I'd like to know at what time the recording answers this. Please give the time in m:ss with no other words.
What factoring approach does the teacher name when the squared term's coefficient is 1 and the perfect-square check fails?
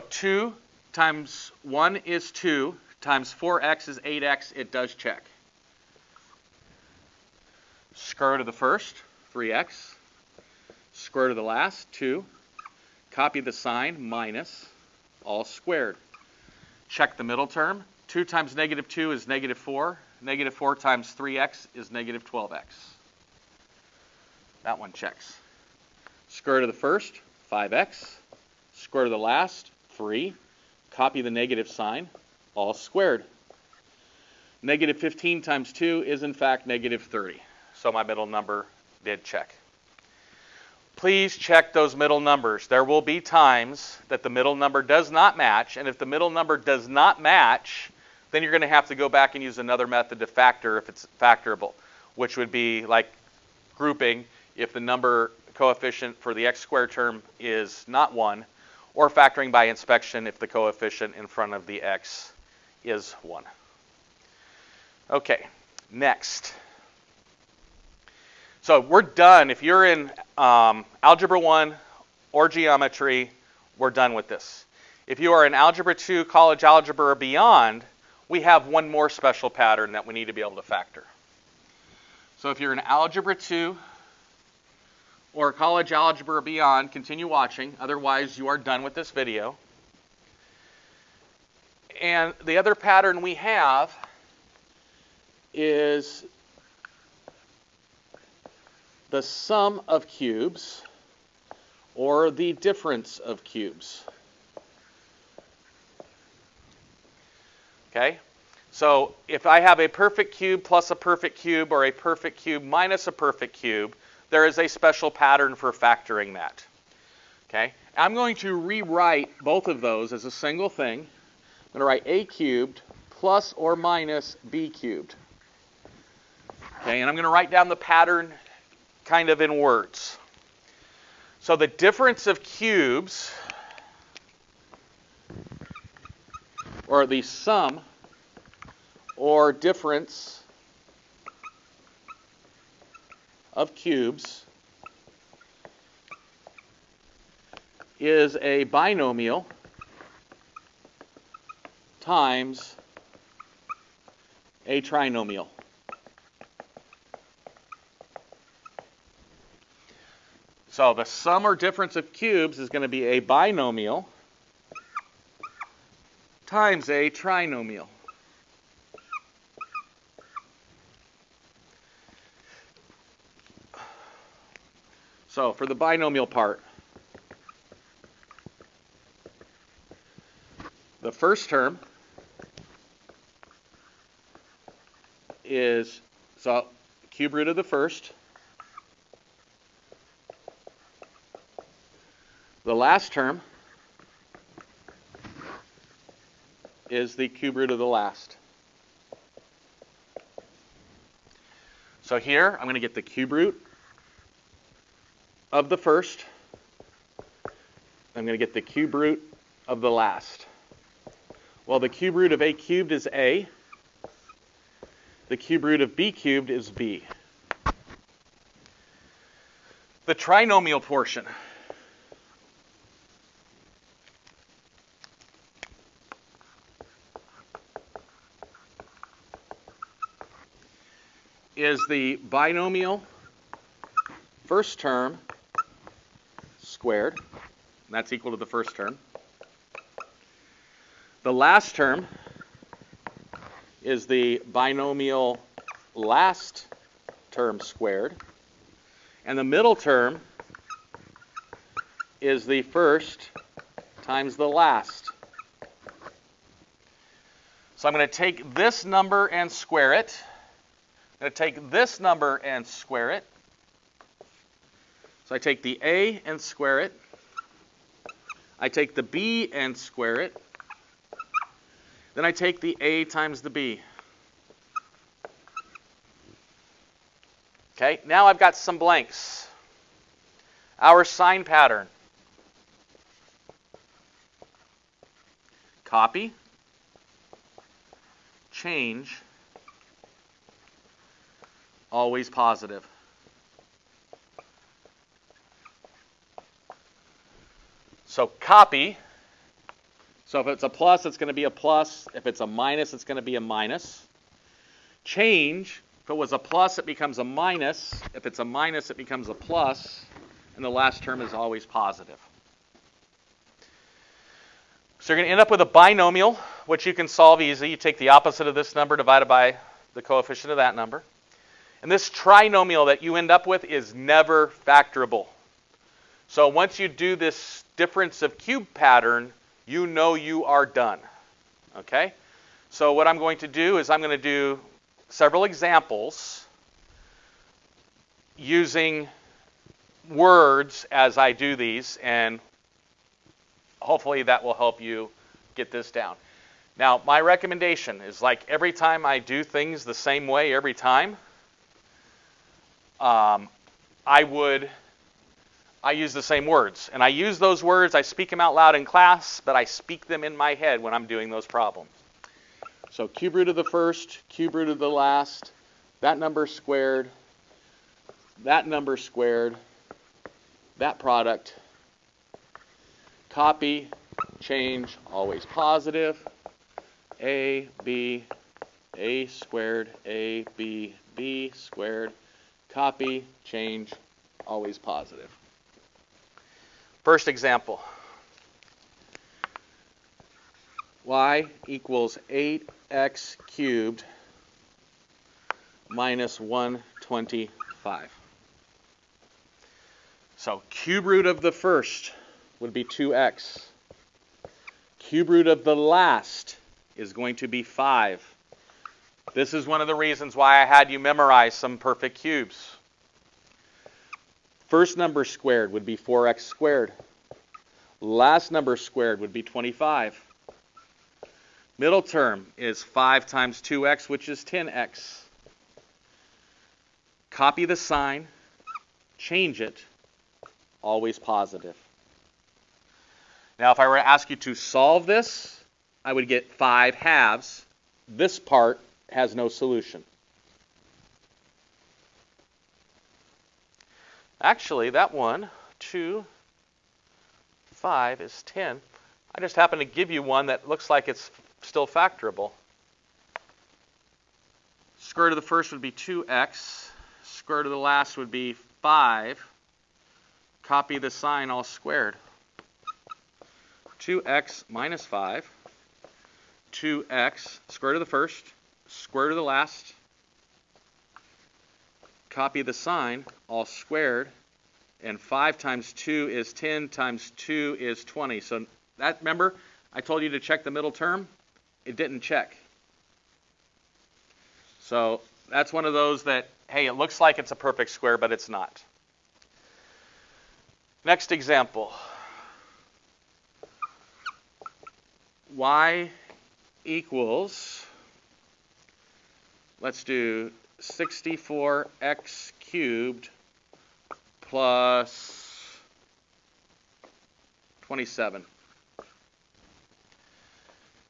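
0:59.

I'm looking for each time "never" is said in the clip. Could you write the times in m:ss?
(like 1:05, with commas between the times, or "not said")
5:23.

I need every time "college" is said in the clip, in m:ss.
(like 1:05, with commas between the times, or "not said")
1:16, 1:25.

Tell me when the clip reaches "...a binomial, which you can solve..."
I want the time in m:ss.
5:15.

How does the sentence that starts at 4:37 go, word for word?
Okay, now I've got some blanks.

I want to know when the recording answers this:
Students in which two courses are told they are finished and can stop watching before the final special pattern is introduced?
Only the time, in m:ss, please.
1:11.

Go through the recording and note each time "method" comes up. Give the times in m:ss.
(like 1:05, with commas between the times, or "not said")
0:49.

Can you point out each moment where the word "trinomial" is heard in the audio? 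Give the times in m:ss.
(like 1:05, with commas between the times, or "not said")
2:34, 2:47, 3:40, 5:22.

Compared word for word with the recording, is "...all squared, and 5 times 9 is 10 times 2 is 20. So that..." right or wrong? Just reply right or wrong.
wrong.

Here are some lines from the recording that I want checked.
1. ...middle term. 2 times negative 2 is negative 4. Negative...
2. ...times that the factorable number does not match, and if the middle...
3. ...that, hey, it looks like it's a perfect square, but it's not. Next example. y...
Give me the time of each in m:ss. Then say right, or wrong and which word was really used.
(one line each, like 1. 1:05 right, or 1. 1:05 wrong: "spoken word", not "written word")
1. 0:17 right
2. 0:43 wrong: "middle", not "factorable"
3. 8:06 right.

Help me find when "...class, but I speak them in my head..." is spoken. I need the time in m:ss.
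5:58.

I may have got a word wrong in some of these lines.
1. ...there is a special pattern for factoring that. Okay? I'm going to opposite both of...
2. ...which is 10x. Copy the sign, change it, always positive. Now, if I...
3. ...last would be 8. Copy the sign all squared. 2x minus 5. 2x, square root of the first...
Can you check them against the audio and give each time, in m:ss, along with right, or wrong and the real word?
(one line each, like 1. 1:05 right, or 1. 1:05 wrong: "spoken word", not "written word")
1. 1:54 wrong: "rewrite", not "opposite"
2. 7:04 right
3. 7:37 wrong: "5", not "8".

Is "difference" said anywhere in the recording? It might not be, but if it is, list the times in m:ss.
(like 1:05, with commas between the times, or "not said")
1:42, 2:11, 2:19, 2:41, 5:27.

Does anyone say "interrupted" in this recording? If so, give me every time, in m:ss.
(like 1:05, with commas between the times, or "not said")
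not said.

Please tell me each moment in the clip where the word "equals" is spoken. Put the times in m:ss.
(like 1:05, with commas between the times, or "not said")
3:58, 6:31, 8:16.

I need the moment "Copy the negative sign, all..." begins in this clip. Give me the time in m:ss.
0:30.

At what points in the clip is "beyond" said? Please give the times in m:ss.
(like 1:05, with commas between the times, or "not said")
1:17, 1:26.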